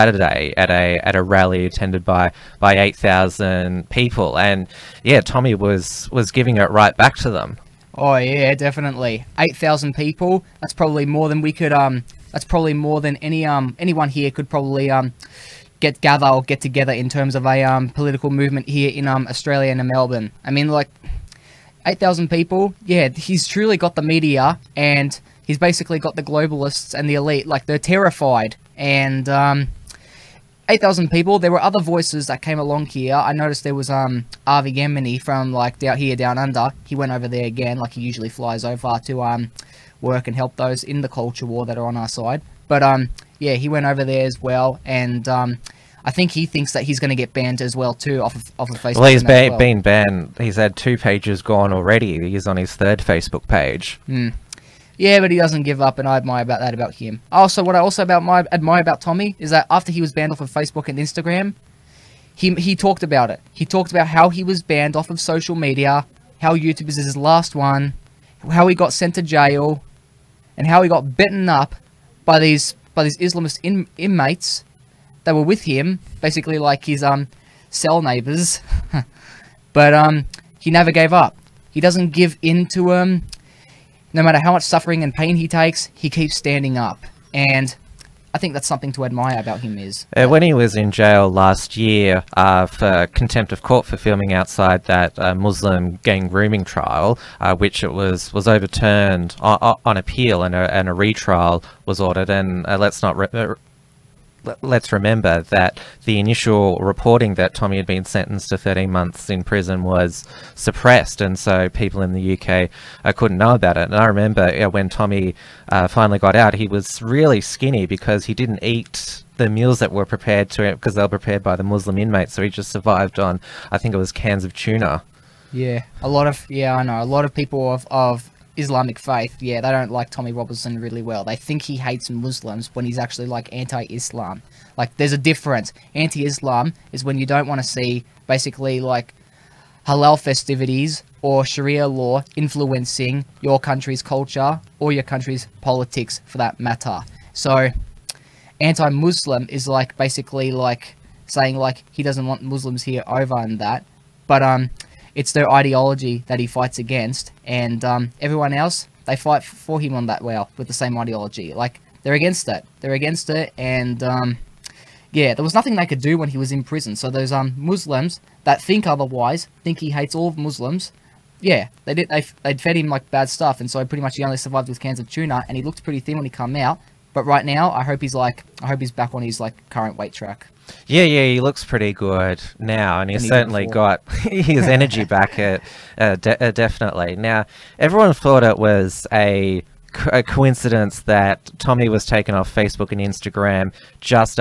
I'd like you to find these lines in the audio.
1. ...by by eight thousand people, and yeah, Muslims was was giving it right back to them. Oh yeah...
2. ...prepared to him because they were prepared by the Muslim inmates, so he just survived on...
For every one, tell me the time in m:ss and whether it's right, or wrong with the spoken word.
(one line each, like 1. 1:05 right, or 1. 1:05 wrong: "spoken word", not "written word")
1. 0:02 wrong: "Tommy", not "Muslims"
2. 2:00 right.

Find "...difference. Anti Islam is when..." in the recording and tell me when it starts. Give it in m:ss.
2:15.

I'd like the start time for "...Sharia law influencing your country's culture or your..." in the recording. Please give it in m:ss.
2:21.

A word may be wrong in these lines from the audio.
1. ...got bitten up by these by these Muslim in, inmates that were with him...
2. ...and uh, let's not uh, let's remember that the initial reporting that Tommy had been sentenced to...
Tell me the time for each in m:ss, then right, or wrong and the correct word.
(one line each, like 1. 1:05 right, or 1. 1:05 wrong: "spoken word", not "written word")
1. 1:10 wrong: "Islamist", not "Muslim"
2. 1:42 right.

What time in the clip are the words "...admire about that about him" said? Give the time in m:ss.
0:56.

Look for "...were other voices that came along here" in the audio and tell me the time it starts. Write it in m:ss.
0:31.